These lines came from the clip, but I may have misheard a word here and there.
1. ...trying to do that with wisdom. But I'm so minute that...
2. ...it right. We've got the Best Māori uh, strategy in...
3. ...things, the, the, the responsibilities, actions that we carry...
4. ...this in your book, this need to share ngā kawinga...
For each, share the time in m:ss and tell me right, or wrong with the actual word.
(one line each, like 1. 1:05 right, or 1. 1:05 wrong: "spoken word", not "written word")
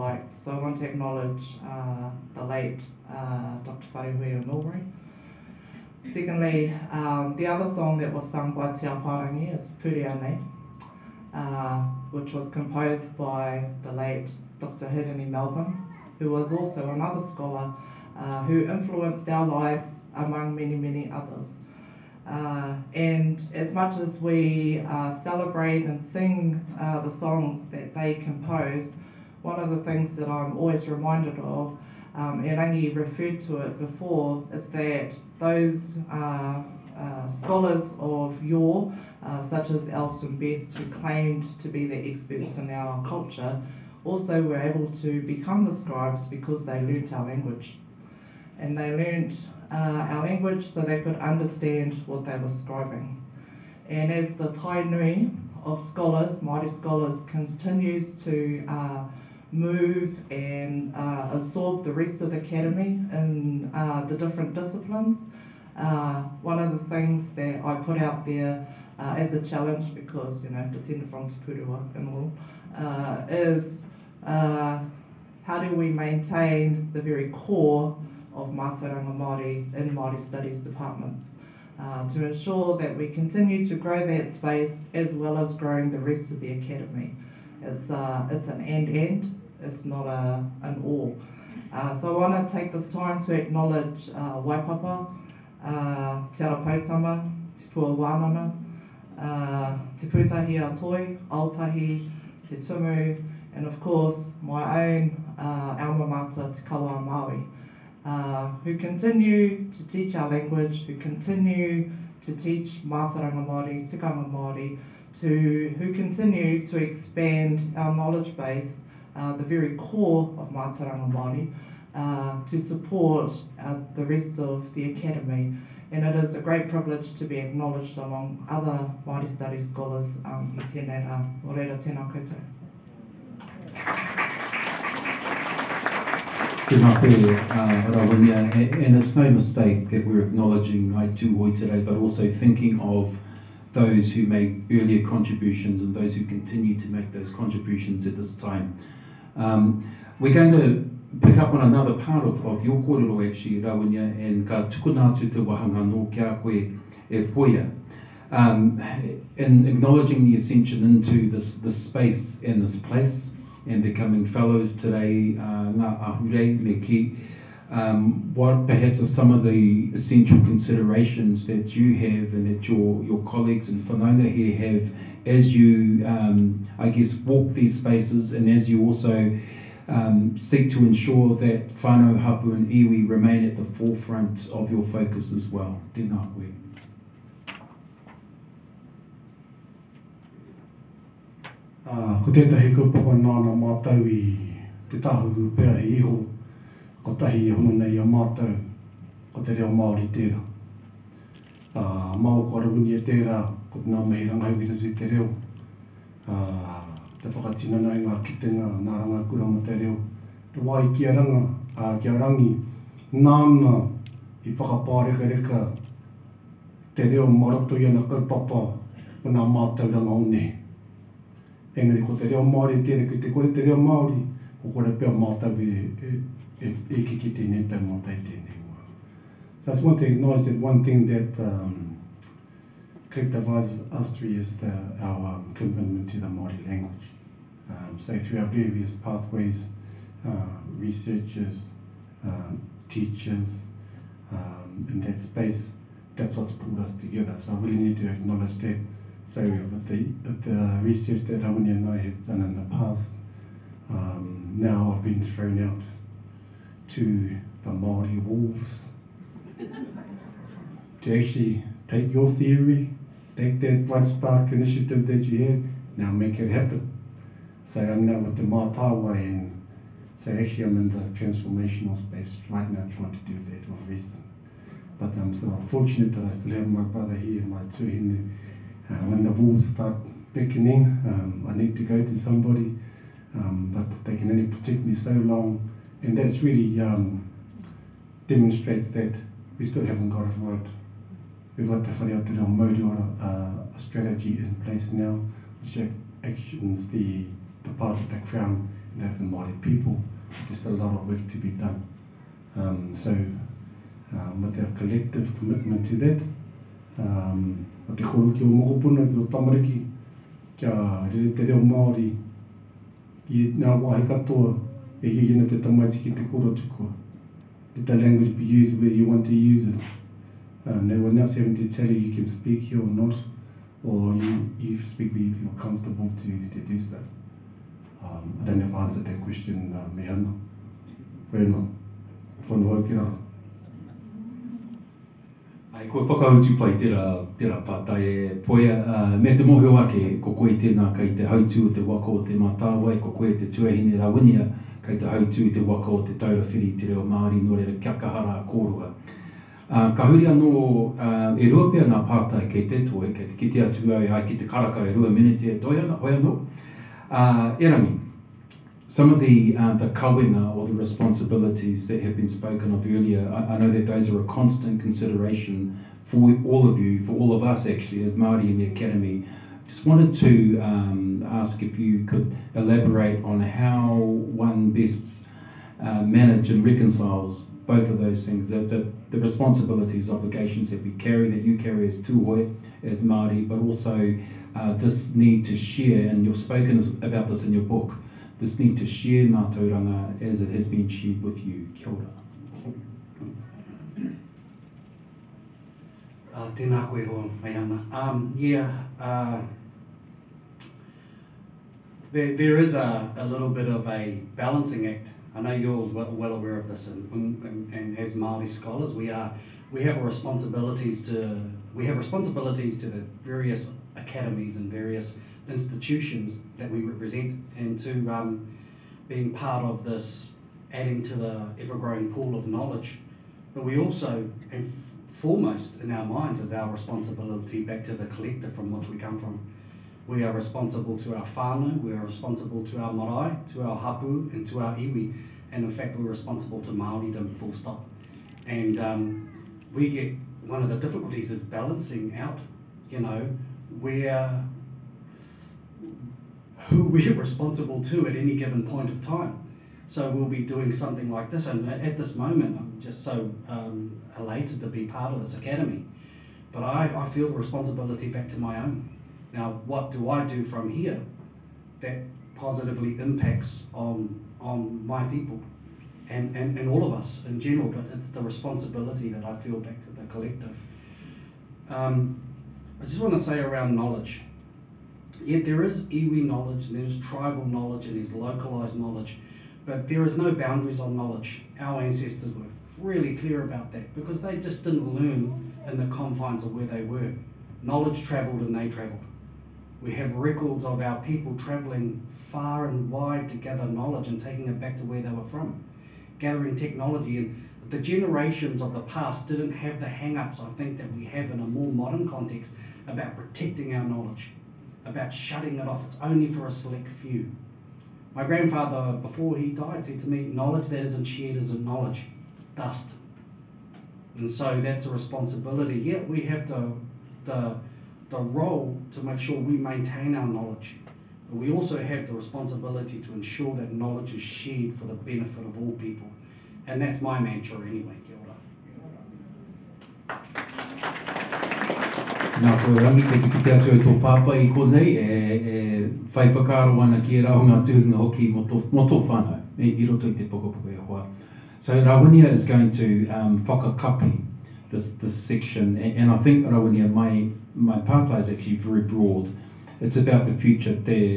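1. 4:32 wrong: "fortunate", not "minute"
2. 4:50 wrong: "Whareatero", not "Best"
3. 6:18 wrong: "obligations", not "actions"
4. 6:27 wrong: "tauranga", not "kawinga".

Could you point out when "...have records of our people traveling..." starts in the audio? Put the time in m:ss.
8:09.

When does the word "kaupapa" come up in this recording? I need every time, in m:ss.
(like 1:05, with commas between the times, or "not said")
3:12, 3:38.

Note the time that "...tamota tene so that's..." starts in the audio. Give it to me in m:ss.
3:47.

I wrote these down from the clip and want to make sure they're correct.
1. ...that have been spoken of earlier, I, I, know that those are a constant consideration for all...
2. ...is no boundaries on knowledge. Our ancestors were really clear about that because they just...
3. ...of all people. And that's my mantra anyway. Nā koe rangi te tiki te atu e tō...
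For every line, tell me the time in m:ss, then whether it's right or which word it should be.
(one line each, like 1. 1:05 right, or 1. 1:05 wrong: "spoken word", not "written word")
1. 6:01 right
2. 8:00 right
3. 8:45 right.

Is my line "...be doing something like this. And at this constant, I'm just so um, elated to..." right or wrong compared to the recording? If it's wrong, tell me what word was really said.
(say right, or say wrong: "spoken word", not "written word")
wrong: "moment", not "constant".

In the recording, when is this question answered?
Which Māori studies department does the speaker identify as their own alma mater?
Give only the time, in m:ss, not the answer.
1:46.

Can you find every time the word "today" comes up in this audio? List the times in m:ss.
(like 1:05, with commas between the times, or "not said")
2:21, 2:44.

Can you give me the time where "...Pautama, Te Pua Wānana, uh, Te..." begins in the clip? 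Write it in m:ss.
1:36.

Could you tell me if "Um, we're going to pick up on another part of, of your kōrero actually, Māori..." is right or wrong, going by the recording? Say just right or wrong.
wrong.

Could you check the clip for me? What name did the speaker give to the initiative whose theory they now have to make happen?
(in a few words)
Blood Spark.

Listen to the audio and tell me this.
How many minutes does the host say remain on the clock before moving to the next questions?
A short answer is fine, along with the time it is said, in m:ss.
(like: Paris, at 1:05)
2, at 5:54.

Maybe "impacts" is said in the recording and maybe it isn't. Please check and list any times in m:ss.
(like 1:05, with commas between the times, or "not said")
7:42.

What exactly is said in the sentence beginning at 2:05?
And it is a great privilege to be acknowledged among other Māori studies scholars um, i tēnei rā.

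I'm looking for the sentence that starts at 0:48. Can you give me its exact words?
And they learnt uh, our language so they could understand what they were scribing.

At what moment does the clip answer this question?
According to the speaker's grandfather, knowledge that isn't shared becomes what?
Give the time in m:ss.
8:32.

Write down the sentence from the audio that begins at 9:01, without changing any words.
So Rawinia is going to um, whakakapi this, this section, and, and I think Rawinia, my, my pāta is actually very broad.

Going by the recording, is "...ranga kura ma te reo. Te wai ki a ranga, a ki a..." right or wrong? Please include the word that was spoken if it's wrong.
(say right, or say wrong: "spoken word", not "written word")
right.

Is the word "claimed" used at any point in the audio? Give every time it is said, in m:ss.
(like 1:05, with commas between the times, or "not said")
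0:40.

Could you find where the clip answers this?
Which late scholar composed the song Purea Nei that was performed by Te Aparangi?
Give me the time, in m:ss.
0:14.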